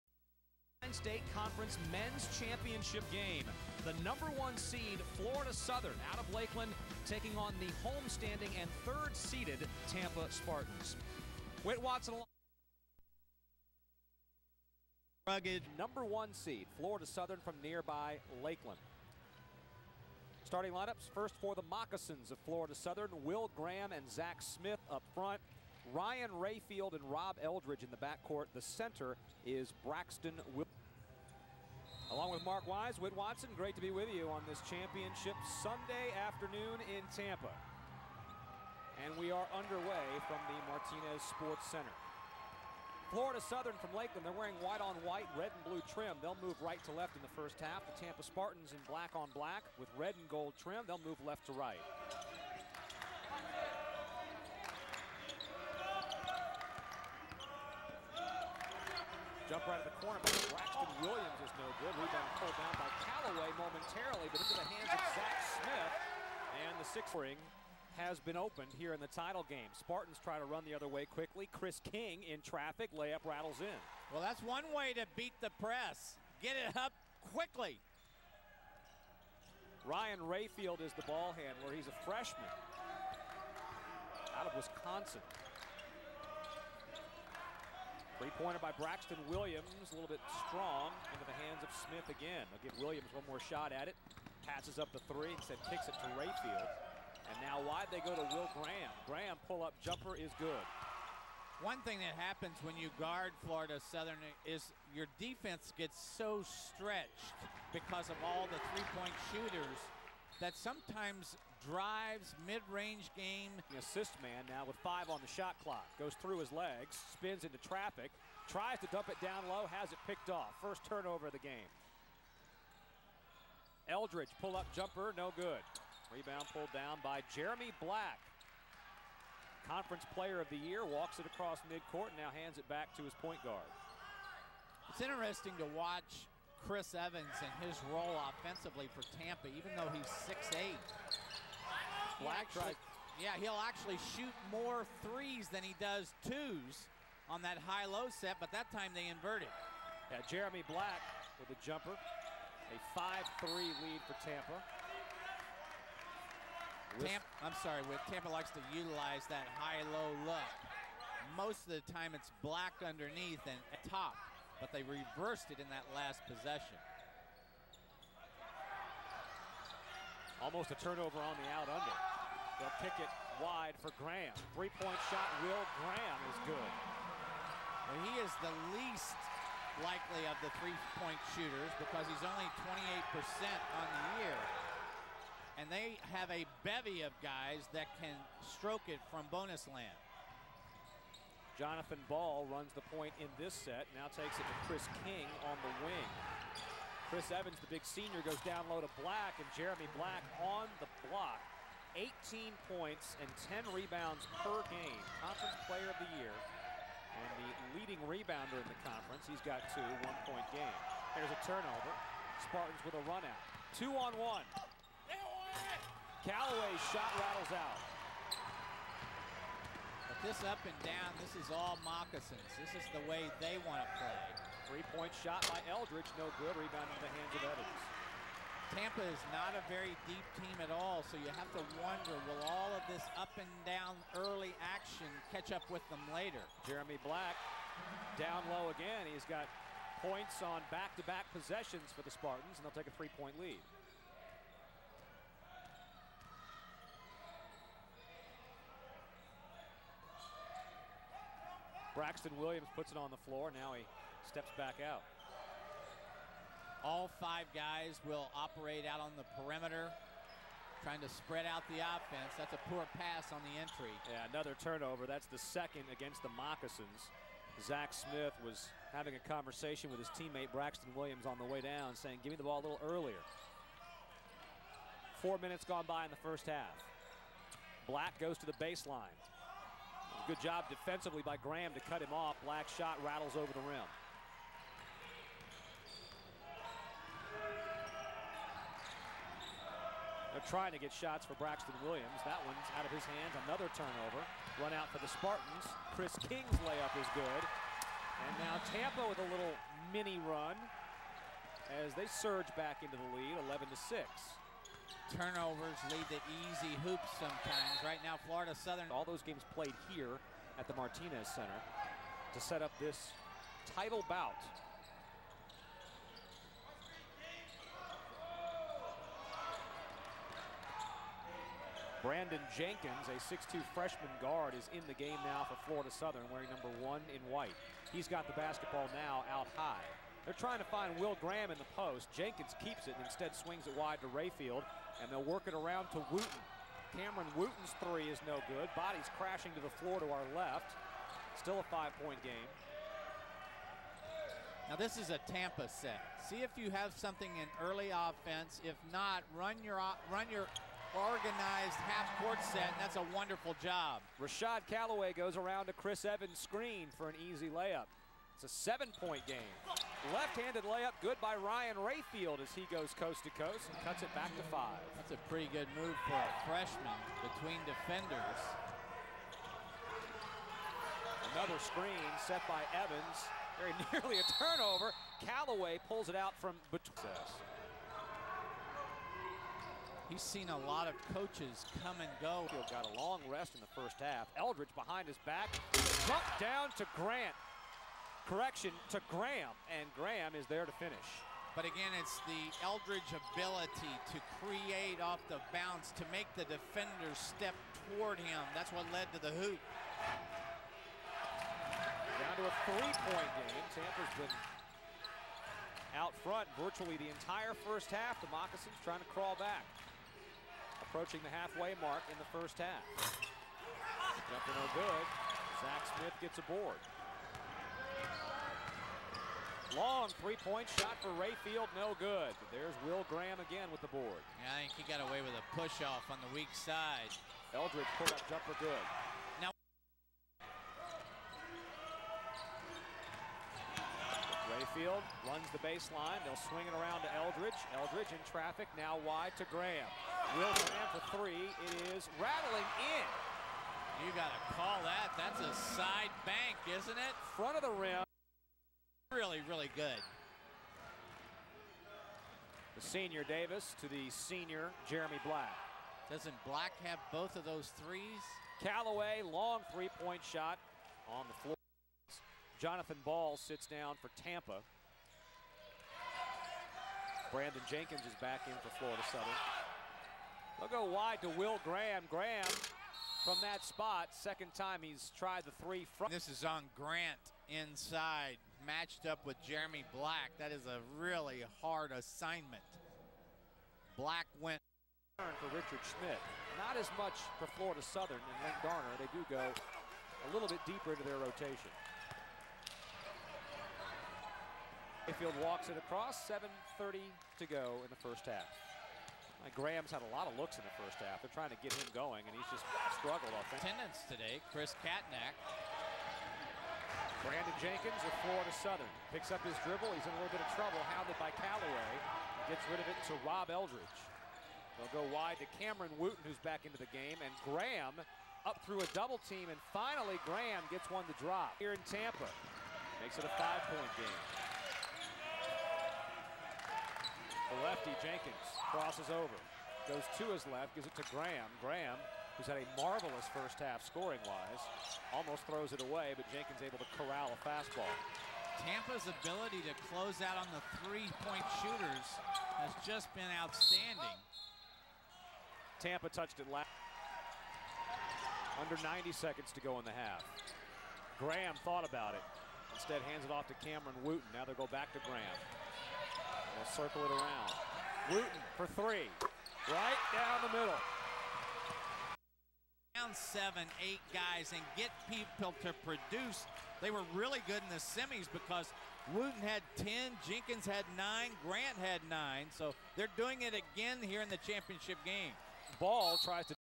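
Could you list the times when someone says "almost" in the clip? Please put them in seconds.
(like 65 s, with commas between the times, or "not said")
170 s, 535 s.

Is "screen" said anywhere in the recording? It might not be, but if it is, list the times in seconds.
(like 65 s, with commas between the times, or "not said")
356 s, 371 s.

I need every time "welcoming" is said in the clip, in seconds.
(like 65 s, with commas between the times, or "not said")
not said.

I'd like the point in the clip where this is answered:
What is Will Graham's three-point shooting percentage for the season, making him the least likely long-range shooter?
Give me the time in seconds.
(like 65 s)
182 s.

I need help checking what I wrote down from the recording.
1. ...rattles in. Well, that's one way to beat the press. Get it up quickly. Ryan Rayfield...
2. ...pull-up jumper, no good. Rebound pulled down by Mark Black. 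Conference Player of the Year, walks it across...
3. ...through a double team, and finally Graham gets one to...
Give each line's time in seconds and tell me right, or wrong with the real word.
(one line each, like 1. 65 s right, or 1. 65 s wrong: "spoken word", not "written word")
1. 73 s right
2. 124 s wrong: "Jeremy", not "Mark"
3. 518 s right.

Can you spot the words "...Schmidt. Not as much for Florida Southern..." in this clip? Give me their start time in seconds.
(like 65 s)
485 s.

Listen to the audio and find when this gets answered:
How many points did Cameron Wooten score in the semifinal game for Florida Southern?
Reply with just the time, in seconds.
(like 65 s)
569 s.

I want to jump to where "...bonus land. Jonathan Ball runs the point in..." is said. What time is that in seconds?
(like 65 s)
189 s.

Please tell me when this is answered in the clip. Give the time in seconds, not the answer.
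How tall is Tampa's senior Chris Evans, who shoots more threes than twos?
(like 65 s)
140 s.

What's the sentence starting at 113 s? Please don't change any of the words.
The assist man now with five on the shot clock.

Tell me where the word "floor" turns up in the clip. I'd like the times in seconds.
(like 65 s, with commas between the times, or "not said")
253 s, 339 s, 461 s.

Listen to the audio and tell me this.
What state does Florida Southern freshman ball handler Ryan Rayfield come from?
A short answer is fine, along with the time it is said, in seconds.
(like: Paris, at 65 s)
Wisconsin, at 84 s.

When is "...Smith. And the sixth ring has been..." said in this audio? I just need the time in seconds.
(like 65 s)
65 s.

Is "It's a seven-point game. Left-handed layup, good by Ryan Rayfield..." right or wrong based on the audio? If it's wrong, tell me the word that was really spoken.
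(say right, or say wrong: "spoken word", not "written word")
right.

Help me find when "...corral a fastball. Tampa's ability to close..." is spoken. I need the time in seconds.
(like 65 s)
536 s.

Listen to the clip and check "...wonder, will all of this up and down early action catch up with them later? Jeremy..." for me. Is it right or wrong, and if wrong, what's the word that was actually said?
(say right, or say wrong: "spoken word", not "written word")
right.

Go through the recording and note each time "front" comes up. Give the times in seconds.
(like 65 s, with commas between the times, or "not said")
25 s, 406 s, 447 s.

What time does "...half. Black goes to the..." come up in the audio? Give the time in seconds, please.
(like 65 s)
276 s.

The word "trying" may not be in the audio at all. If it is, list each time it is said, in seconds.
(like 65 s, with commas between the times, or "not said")
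260 s, 290 s, 330 s, 408 s, 501 s.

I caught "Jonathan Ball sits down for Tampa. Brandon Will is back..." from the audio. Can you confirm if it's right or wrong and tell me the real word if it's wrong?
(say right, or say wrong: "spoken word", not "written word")
wrong: "Jenkins", not "Will".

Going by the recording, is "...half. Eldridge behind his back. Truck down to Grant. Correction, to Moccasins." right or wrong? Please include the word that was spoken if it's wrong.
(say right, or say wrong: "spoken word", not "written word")
wrong: "Graham", not "Moccasins".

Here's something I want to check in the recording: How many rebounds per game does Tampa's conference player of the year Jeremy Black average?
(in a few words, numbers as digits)
10.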